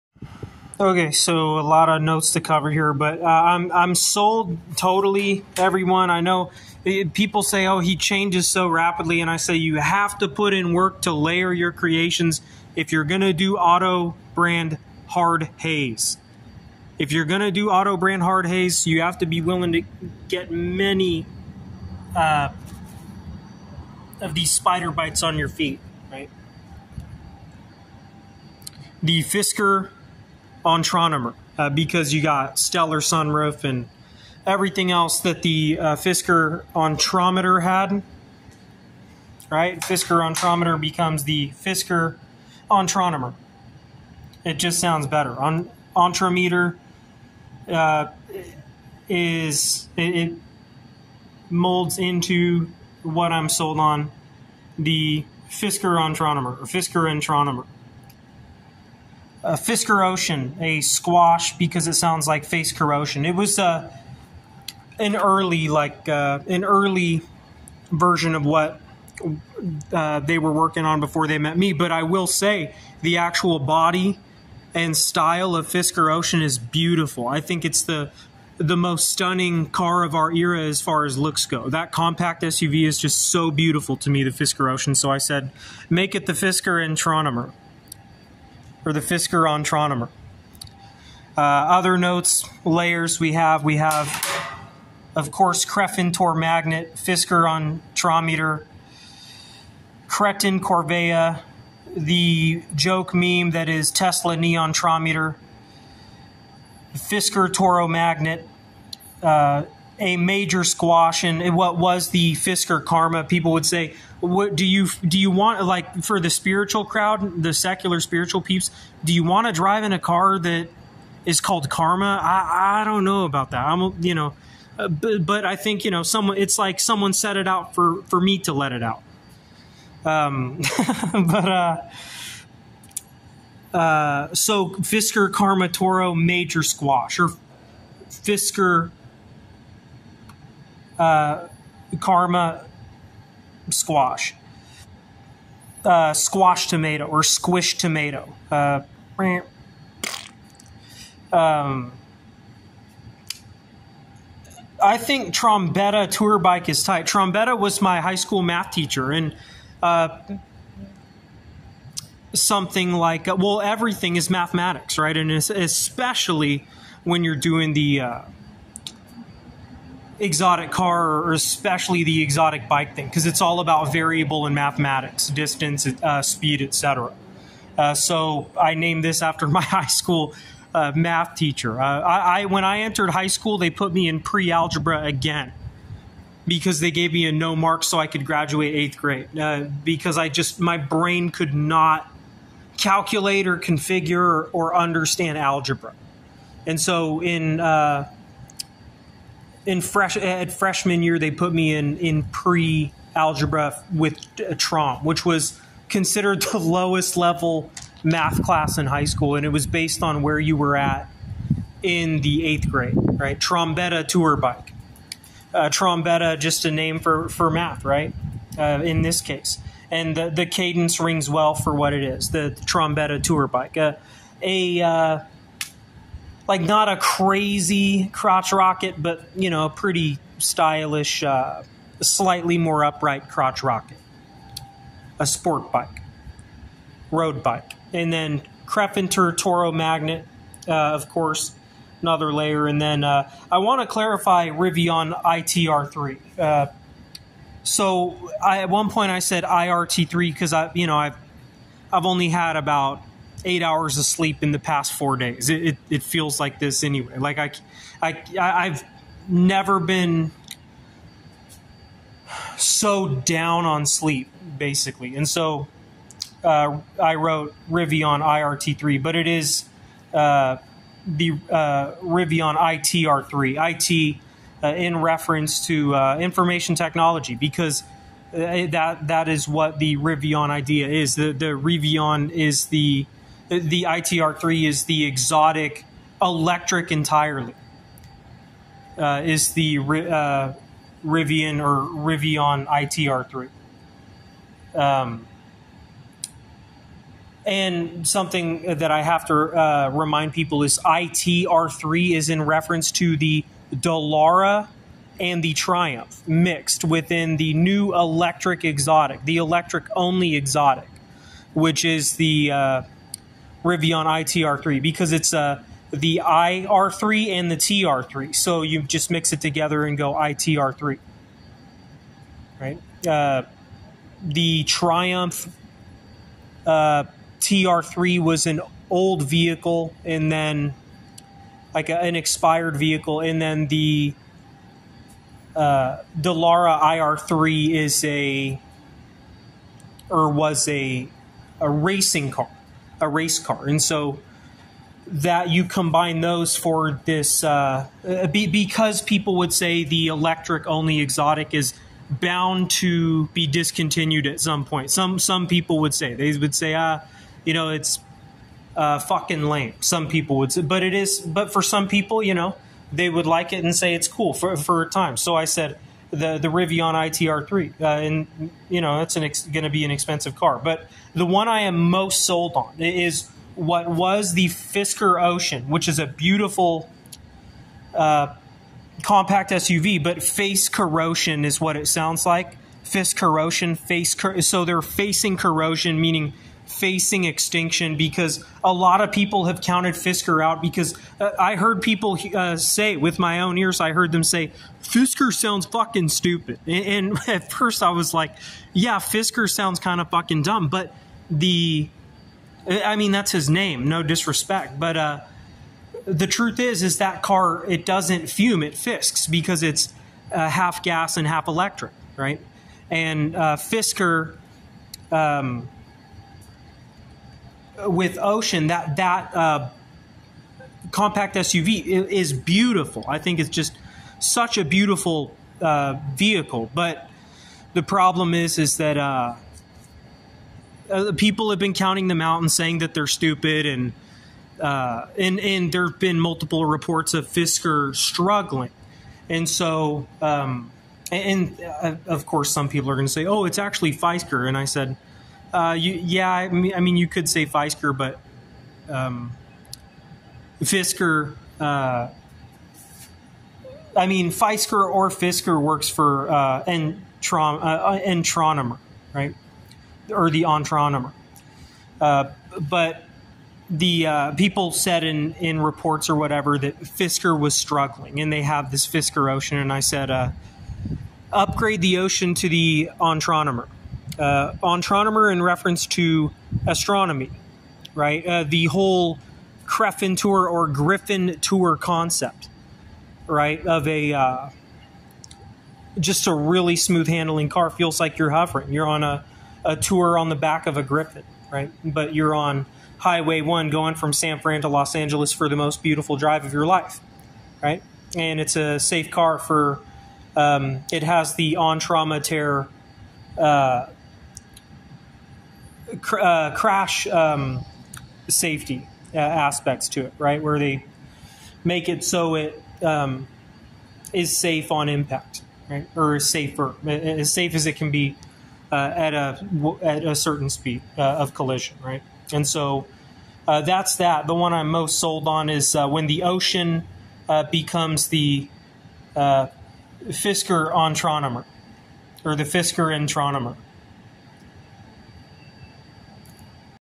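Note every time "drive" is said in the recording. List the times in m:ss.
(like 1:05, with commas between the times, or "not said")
1:59, 8:16.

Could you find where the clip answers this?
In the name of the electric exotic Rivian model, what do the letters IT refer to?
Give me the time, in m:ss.
4:36.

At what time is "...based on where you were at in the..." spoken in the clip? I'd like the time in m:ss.
3:29.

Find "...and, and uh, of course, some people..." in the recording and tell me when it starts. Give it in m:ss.
7:21.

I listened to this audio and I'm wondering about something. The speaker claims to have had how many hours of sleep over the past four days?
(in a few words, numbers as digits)
8.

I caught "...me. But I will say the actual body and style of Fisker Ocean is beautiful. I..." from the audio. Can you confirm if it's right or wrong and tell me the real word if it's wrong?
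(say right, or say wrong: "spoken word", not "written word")
right.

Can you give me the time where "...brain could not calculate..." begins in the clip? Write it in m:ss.
3:10.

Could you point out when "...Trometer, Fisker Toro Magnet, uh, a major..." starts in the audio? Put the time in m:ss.
1:44.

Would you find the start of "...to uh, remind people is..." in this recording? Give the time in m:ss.
4:59.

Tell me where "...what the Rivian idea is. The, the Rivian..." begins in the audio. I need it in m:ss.
4:39.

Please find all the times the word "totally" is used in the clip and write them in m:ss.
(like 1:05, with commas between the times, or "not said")
0:04.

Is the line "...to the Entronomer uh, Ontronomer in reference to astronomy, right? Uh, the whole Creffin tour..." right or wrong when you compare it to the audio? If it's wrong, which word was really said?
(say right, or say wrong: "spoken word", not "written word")
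right.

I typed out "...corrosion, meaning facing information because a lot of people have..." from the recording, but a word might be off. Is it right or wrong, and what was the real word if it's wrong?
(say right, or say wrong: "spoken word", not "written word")
wrong: "extinction", not "information".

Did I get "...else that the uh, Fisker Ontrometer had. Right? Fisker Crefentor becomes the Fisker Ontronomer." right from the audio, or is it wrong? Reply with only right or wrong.
wrong.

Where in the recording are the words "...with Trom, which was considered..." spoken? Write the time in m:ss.
3:23.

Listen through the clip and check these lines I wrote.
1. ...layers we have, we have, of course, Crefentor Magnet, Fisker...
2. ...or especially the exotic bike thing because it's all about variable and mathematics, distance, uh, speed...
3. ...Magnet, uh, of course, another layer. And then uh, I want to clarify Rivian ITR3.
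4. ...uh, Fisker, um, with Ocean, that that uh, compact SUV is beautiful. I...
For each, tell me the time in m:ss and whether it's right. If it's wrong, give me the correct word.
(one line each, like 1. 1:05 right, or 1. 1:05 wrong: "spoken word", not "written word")
1. 1:32 right
2. 2:51 right
3. 3:59 right
4. 6:53 right.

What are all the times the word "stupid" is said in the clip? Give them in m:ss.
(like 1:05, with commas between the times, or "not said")
6:36, 7:13.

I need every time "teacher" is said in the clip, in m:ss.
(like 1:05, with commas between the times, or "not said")
2:38, 3:01.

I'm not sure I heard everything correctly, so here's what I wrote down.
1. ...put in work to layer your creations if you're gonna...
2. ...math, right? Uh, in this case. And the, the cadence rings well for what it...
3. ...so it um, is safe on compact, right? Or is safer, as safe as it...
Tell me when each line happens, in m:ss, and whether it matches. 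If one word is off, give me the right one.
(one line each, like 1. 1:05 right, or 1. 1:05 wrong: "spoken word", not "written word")
1. 0:10 right
2. 3:37 right
3. 8:32 wrong: "impact", not "compact".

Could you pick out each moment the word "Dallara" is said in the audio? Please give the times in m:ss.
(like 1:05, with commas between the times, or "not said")
5:03, 5:36.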